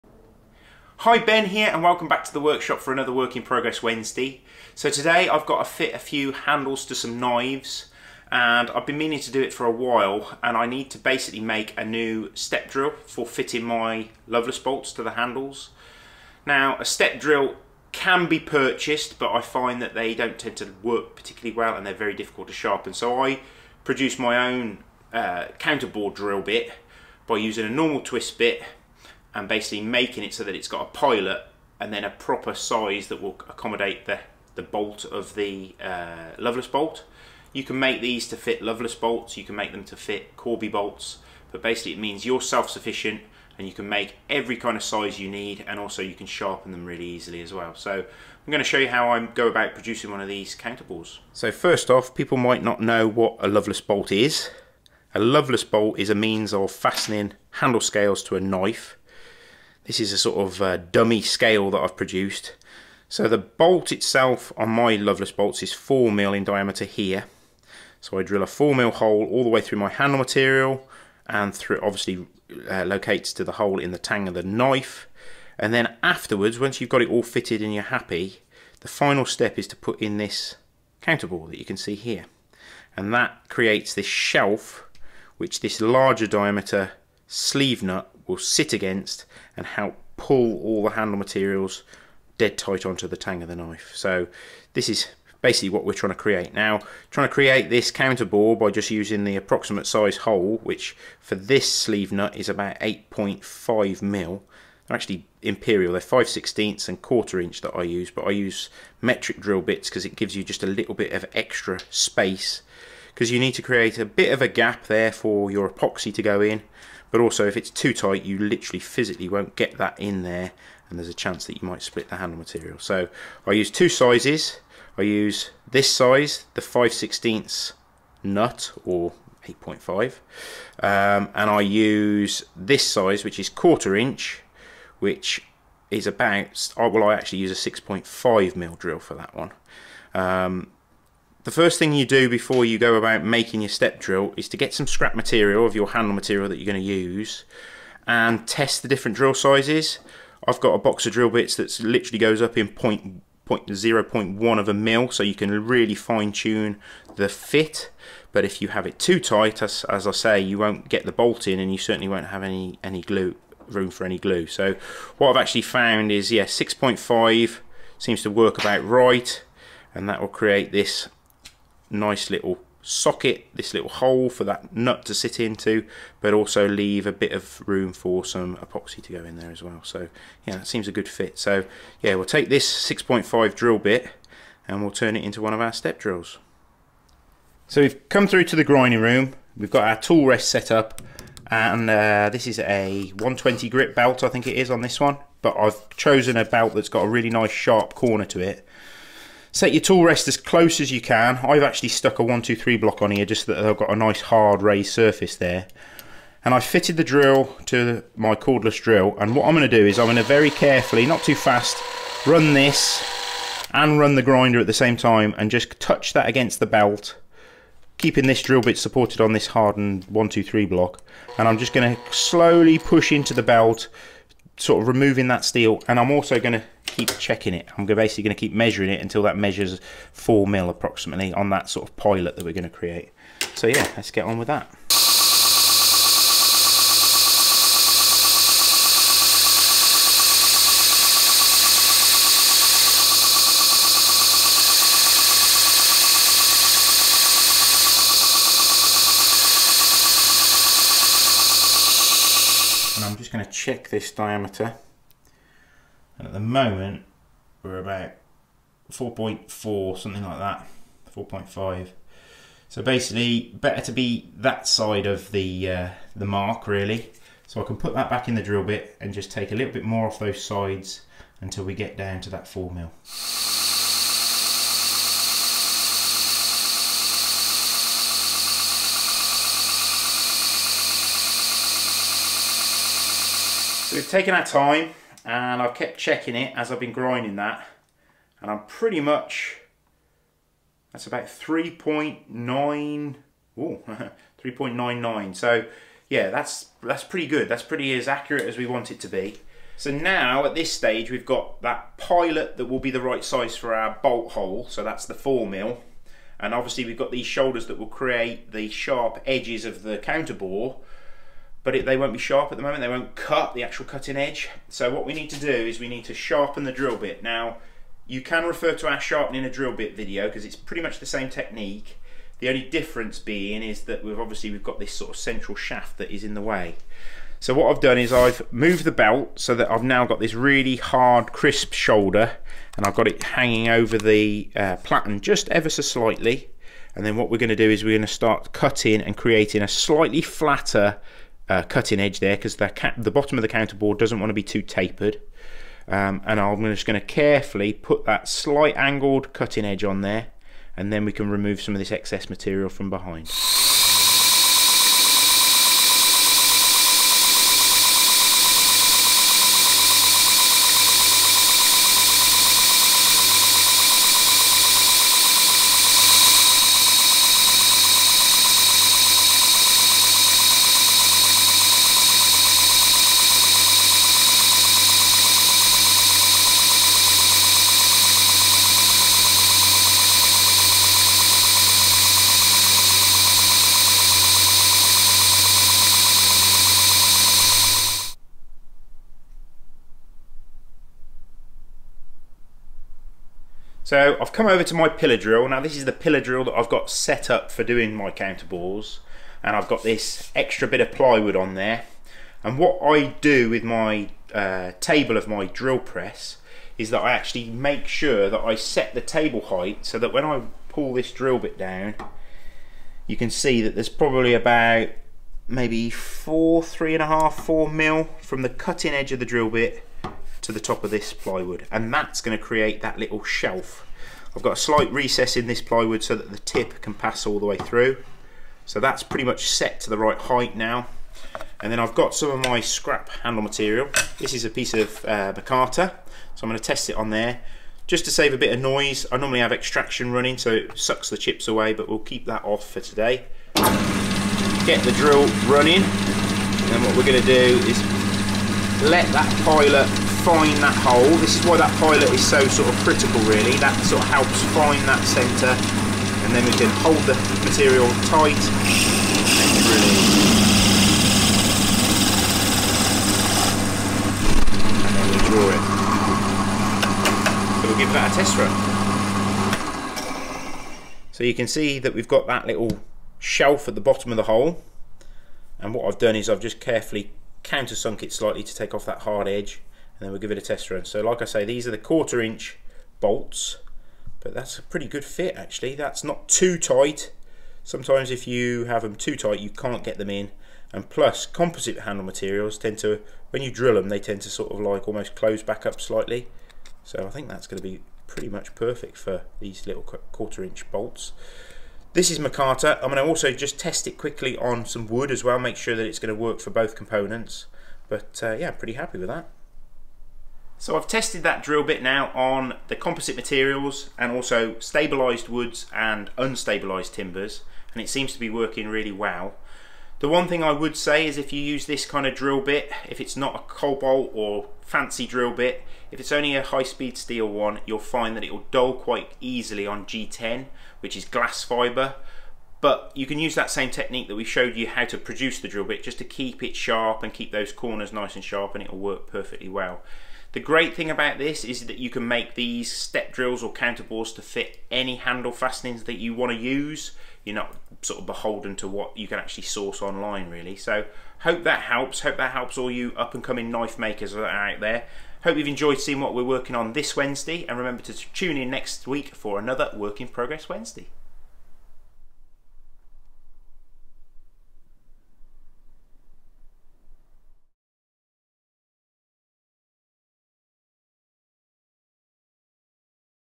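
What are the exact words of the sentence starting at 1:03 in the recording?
So the bolt itself on my Loveless bolts is 4mm in diameter here.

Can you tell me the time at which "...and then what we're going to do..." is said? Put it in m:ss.
5:36.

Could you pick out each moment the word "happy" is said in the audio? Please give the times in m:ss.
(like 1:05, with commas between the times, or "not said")
1:17, 8:28.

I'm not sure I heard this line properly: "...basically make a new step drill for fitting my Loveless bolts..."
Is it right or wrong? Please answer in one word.
right.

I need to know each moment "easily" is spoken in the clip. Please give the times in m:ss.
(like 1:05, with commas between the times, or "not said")
0:47, 8:49.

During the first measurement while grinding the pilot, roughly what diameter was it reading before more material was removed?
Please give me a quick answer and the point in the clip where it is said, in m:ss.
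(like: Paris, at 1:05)
4.4, at 4:18.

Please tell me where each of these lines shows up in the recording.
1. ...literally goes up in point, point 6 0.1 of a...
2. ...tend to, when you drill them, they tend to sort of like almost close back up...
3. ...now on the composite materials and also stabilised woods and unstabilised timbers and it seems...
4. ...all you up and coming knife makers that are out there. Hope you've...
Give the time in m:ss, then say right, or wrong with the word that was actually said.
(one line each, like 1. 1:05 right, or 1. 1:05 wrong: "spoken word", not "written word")
1. 2:31 wrong: "0", not "6"
2. 8:12 right
3. 8:31 right
4. 9:12 right.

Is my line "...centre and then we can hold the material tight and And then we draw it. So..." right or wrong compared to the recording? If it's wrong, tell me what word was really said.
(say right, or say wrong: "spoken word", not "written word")
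right.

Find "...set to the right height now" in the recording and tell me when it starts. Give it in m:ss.
7:09.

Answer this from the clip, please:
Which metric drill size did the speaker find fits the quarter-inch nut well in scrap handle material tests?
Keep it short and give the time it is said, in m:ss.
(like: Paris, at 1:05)
6.5 mil, at 2:17.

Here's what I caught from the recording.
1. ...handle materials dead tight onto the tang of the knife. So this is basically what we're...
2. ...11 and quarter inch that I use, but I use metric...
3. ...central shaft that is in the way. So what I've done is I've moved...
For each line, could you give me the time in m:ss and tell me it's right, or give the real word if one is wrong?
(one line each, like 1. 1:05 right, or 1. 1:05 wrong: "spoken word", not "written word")
1. 1:30 right
2. 1:46 wrong: "16", not "11"
3. 5:25 right.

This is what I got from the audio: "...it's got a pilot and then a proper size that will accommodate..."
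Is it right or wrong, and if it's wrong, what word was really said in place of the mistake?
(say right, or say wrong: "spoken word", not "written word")
right.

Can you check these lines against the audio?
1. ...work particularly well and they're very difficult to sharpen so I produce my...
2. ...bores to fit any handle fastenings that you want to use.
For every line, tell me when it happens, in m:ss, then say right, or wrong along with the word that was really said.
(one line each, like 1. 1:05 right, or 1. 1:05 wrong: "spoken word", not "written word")
1. 0:20 right
2. 9:03 right.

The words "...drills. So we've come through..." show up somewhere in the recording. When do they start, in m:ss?
3:05.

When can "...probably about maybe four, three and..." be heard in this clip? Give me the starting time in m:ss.
6:53.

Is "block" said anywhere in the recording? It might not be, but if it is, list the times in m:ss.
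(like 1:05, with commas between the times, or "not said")
3:22, 3:40.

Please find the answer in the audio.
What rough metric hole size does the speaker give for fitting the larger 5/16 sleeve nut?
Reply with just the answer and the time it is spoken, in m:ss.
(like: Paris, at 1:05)
8.5 mil, at 1:42.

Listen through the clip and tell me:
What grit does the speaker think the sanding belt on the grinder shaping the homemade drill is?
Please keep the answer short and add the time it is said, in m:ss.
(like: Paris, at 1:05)
120, at 3:13.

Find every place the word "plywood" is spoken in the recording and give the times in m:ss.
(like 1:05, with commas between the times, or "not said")
6:40, 7:01, 7:05.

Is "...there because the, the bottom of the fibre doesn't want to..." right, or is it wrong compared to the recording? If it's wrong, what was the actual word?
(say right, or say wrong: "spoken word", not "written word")
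wrong: "counterbore", not "fibre".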